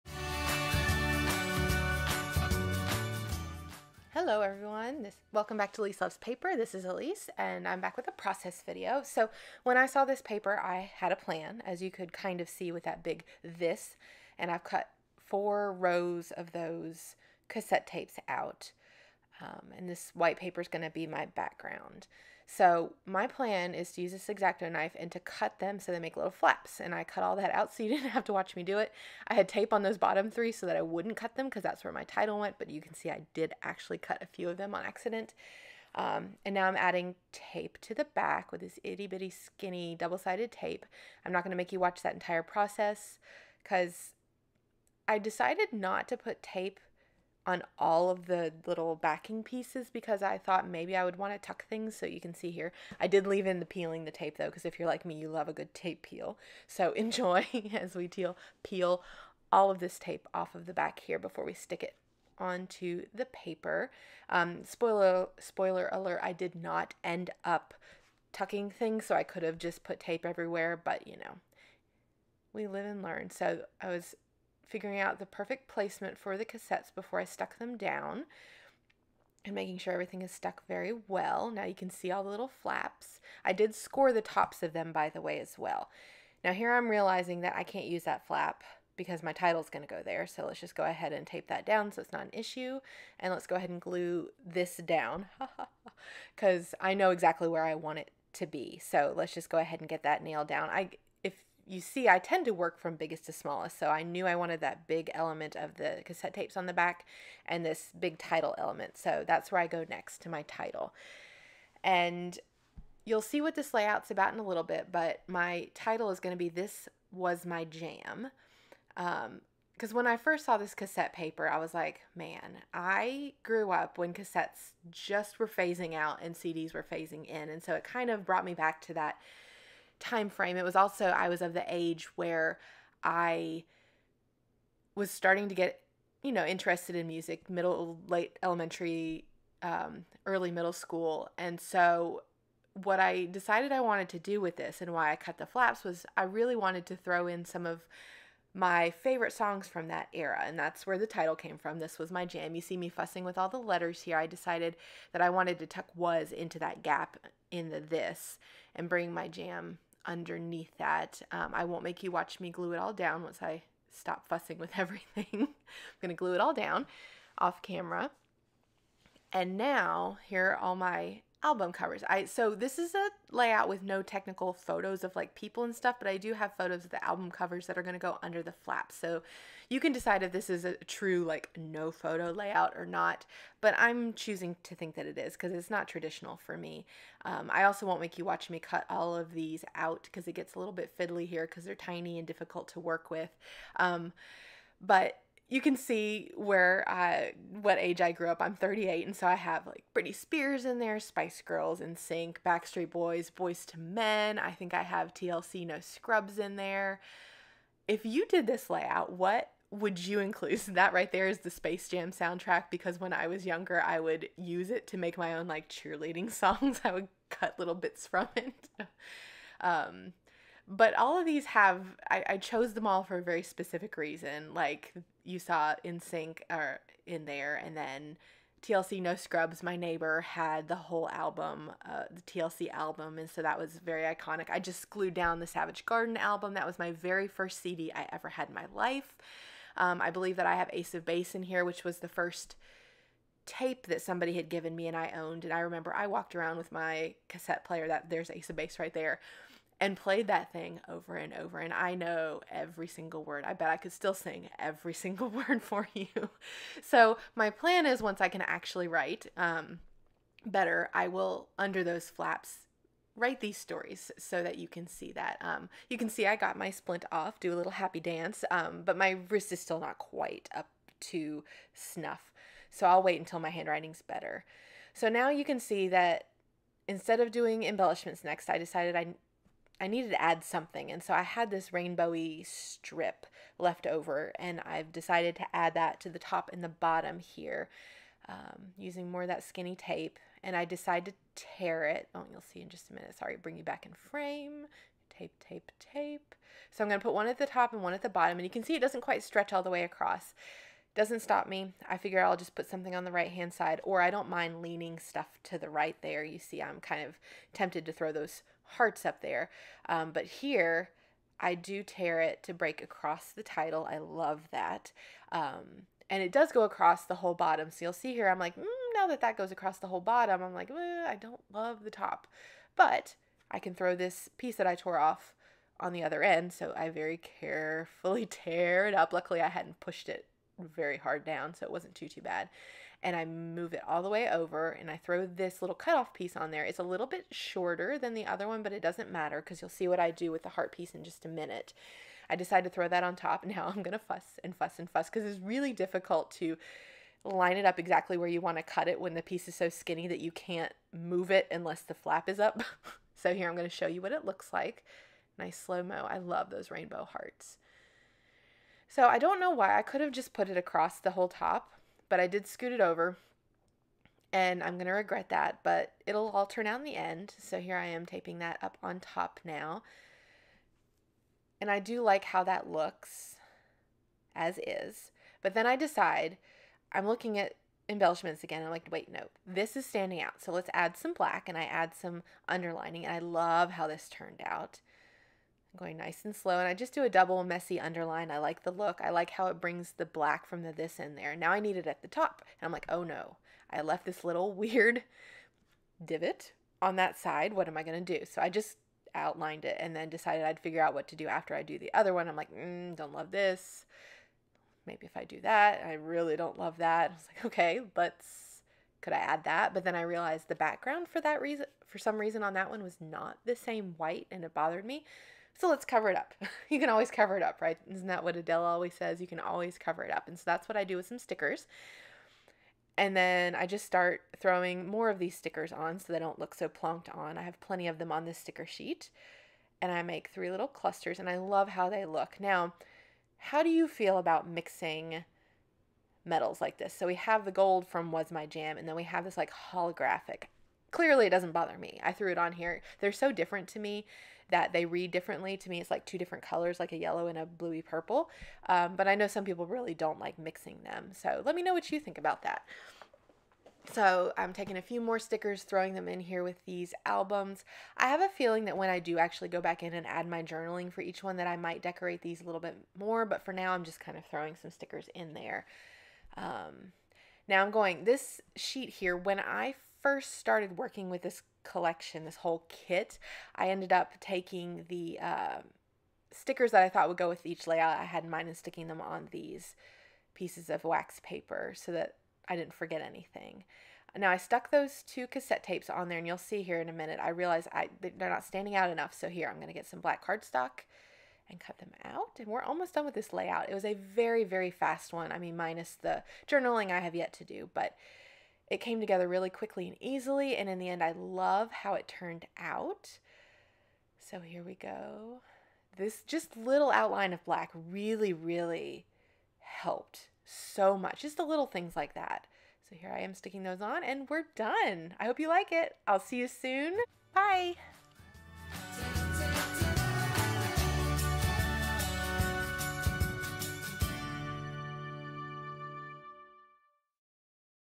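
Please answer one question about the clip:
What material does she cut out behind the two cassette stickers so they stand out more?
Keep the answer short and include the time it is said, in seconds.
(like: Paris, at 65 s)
Black cardstock, at 490 s.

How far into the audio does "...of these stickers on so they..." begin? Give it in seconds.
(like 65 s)
425 s.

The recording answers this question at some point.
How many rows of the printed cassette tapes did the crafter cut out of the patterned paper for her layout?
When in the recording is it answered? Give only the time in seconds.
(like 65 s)
15 s.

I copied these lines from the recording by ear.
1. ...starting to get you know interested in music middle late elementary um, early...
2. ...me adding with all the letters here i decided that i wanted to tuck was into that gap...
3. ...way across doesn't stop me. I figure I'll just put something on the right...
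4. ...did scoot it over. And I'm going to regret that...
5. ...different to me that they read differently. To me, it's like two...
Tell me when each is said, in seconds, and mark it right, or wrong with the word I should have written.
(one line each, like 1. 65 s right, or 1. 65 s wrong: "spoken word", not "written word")
1. 135 s right
2. 152 s wrong: "fussing", not "adding"
3. 299 s right
4. 362 s right
5. 443 s right.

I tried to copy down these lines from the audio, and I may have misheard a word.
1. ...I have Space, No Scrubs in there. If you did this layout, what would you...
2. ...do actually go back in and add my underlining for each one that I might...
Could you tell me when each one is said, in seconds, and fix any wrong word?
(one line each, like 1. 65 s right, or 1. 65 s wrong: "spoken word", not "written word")
1. 204 s wrong: "TLC", not "Space"
2. 458 s wrong: "journaling", not "underlining".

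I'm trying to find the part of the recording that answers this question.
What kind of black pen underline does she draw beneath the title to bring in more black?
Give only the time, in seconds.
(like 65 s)
387 s.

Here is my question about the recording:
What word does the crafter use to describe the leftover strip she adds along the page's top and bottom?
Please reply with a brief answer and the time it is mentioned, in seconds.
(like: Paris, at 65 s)
Rainbowy, at 281 s.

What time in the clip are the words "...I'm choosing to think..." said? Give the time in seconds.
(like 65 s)
183 s.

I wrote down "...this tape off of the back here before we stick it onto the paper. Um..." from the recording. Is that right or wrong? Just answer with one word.
right.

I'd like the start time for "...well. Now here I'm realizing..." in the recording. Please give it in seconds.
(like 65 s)
85 s.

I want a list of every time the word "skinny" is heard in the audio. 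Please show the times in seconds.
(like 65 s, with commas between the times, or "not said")
39 s, 289 s, 349 s.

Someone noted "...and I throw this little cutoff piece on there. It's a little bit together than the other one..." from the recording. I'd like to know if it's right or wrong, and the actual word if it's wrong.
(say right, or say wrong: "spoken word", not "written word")
wrong: "shorter", not "together".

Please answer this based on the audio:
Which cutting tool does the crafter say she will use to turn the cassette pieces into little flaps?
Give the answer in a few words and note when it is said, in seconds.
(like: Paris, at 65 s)
Exacto knife, at 24 s.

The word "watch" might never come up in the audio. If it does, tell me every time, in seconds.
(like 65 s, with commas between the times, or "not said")
28 s, 41 s, 162 s, 188 s.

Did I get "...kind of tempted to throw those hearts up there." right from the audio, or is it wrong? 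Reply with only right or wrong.
right.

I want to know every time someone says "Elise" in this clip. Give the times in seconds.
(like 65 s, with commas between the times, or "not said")
6 s.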